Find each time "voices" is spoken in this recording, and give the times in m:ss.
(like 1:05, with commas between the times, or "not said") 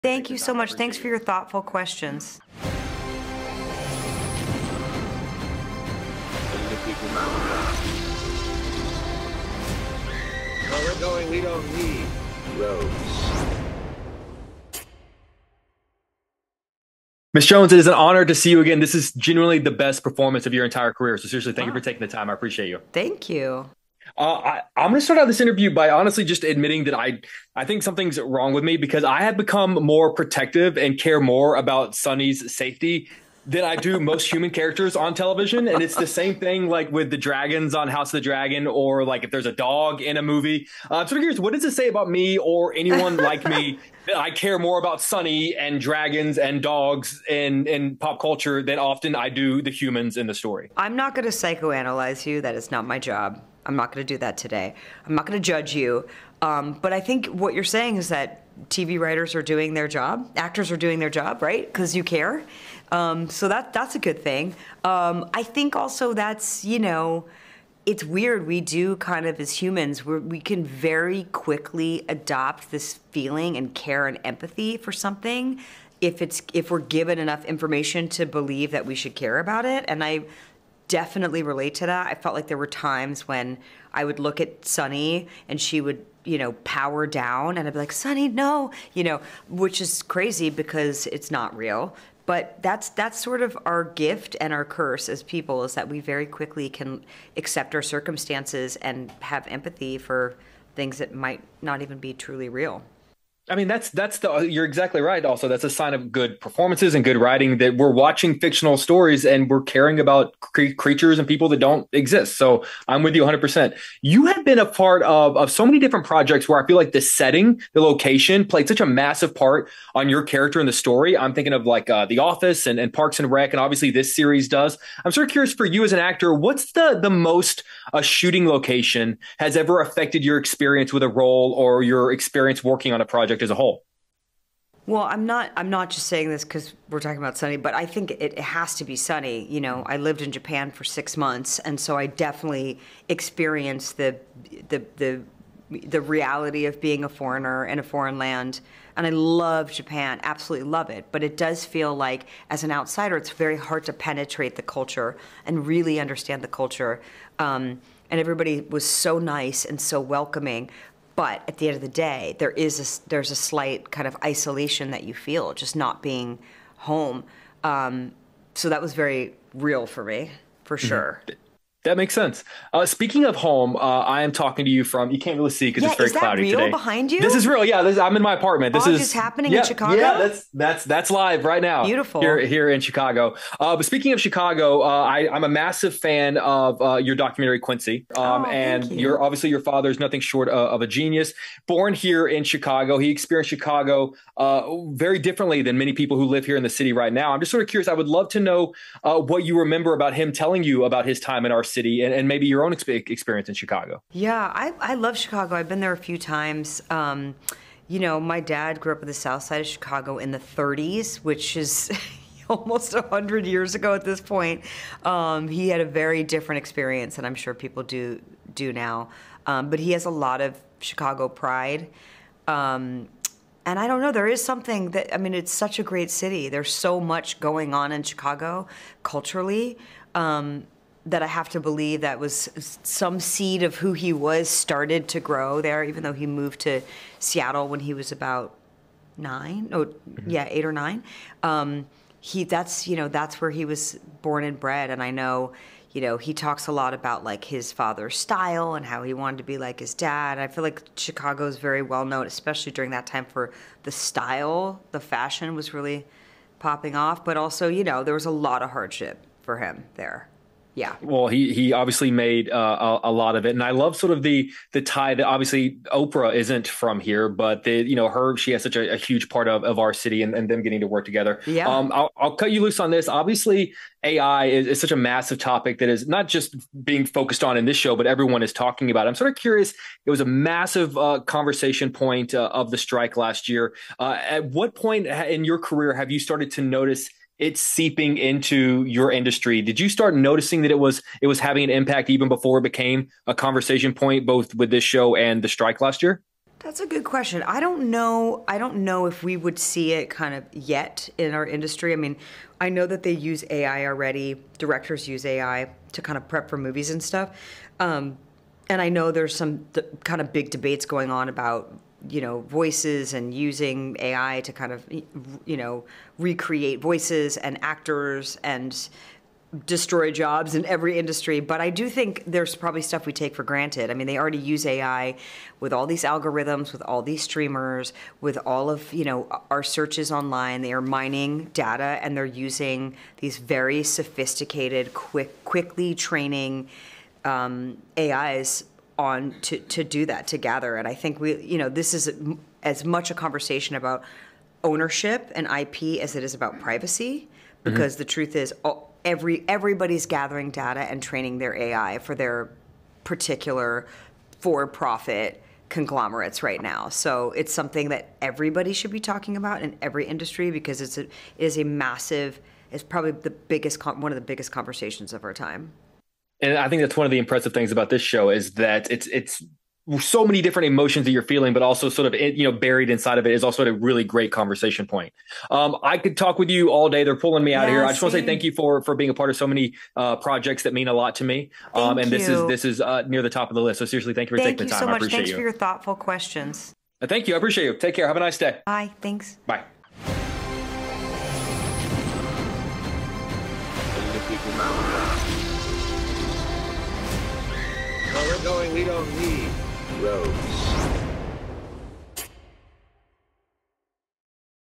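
5:12, 5:16.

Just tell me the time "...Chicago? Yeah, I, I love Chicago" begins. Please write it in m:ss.
3:23.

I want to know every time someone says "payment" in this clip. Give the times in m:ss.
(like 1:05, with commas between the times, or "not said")
not said.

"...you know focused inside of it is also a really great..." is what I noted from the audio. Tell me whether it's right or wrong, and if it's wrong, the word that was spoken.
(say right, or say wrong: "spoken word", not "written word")
wrong: "buried", not "focused".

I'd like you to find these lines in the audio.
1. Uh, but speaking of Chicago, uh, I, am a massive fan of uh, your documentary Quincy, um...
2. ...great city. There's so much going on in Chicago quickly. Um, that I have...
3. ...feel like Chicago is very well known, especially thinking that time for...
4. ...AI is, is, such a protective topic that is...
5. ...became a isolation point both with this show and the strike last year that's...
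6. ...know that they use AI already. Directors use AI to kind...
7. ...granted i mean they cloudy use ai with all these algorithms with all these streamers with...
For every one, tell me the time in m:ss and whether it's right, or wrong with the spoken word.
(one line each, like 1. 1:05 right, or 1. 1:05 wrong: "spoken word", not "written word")
1. 3:03 right
2. 3:45 wrong: "culturally", not "quickly"
3. 4:10 wrong: "during", not "thinking"
4. 4:34 wrong: "massive", not "protective"
5. 4:52 wrong: "conversation", not "isolation"
6. 5:02 right
7. 5:23 wrong: "already", not "cloudy".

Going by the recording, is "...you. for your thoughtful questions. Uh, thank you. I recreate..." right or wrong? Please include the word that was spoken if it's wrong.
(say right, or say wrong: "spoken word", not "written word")
wrong: "appreciate", not "recreate".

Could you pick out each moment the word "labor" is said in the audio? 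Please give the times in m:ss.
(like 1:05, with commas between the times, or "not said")
not said.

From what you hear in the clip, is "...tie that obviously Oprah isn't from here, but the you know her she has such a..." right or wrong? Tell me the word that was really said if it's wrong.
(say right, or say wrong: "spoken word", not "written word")
right.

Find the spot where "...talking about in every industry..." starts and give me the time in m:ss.
5:58.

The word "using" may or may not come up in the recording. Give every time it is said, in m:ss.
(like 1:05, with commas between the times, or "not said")
5:13, 5:32.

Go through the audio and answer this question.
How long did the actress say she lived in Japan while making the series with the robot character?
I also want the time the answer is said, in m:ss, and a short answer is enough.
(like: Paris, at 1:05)
6 months, at 2:20.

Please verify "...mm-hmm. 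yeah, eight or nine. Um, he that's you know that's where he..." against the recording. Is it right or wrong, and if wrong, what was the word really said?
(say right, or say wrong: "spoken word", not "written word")
right.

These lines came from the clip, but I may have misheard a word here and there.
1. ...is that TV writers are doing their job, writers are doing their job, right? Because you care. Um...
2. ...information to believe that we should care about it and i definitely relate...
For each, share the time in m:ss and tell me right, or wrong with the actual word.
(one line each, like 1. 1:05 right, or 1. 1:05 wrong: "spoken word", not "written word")
1. 0:57 wrong: "actors", not "writers"
2. 1:17 right.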